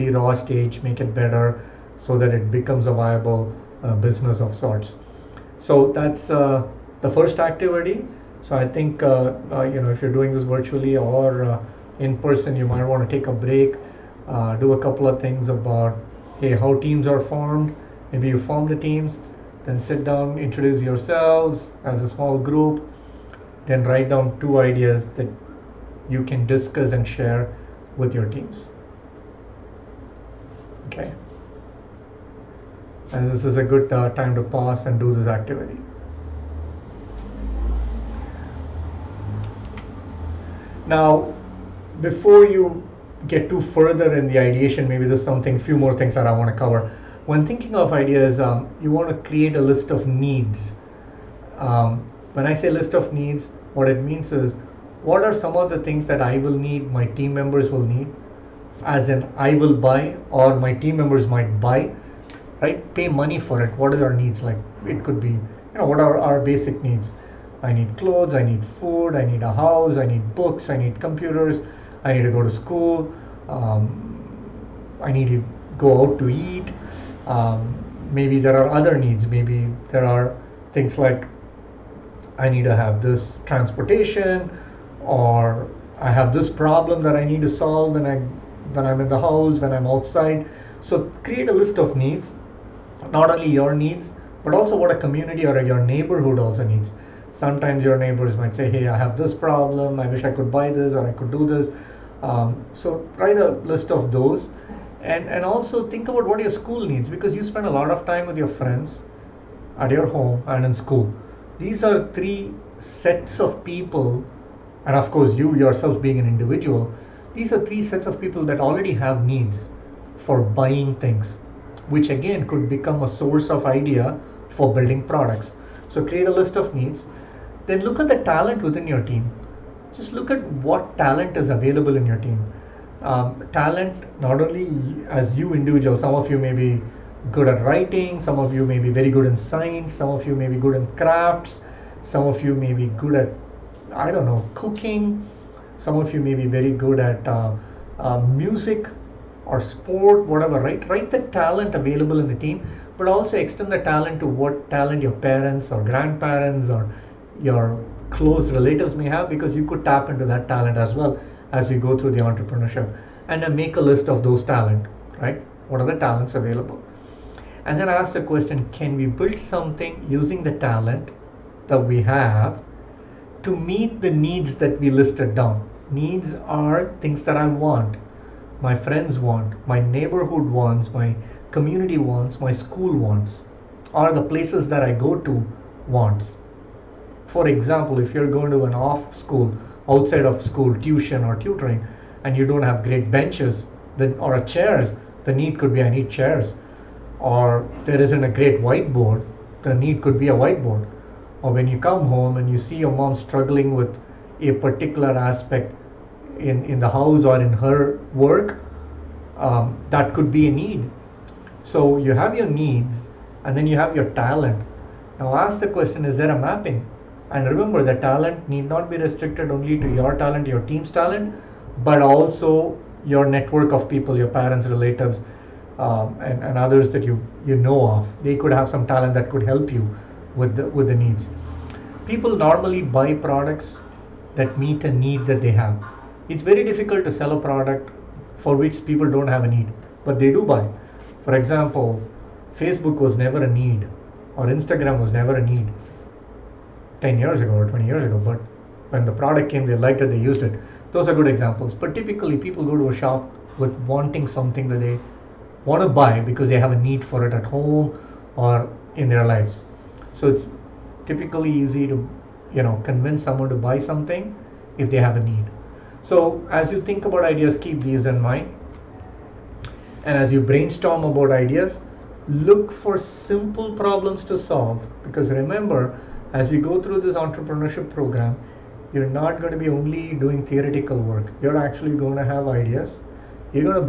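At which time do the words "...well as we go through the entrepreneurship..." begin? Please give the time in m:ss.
2:40.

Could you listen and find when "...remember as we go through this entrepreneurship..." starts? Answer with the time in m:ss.
4:35.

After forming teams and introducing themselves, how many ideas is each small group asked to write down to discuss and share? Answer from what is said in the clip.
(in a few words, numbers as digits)
2.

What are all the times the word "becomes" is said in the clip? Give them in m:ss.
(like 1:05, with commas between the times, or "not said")
0:02, 2:02.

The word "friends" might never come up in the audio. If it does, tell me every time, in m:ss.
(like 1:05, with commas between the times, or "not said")
1:48, 2:58.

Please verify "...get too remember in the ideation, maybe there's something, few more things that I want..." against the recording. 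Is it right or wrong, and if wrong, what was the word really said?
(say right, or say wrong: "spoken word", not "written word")
wrong: "further", not "remember".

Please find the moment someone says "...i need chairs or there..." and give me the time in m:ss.
3:15.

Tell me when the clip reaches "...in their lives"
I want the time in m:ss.
4:18.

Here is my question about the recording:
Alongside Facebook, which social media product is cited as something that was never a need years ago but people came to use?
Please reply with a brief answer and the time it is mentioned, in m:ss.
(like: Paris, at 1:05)
Instagram, at 4:04.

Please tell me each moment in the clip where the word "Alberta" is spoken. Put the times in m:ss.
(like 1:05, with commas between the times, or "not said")
not said.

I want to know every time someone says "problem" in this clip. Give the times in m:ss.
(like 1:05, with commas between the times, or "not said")
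1:26, 1:39, 4:33.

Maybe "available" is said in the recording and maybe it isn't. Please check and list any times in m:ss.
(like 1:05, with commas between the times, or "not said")
2:11, 2:31, 2:46.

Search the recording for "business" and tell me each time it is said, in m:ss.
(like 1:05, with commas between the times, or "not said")
0:03.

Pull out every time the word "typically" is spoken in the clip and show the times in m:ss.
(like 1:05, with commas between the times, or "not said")
4:11, 4:21.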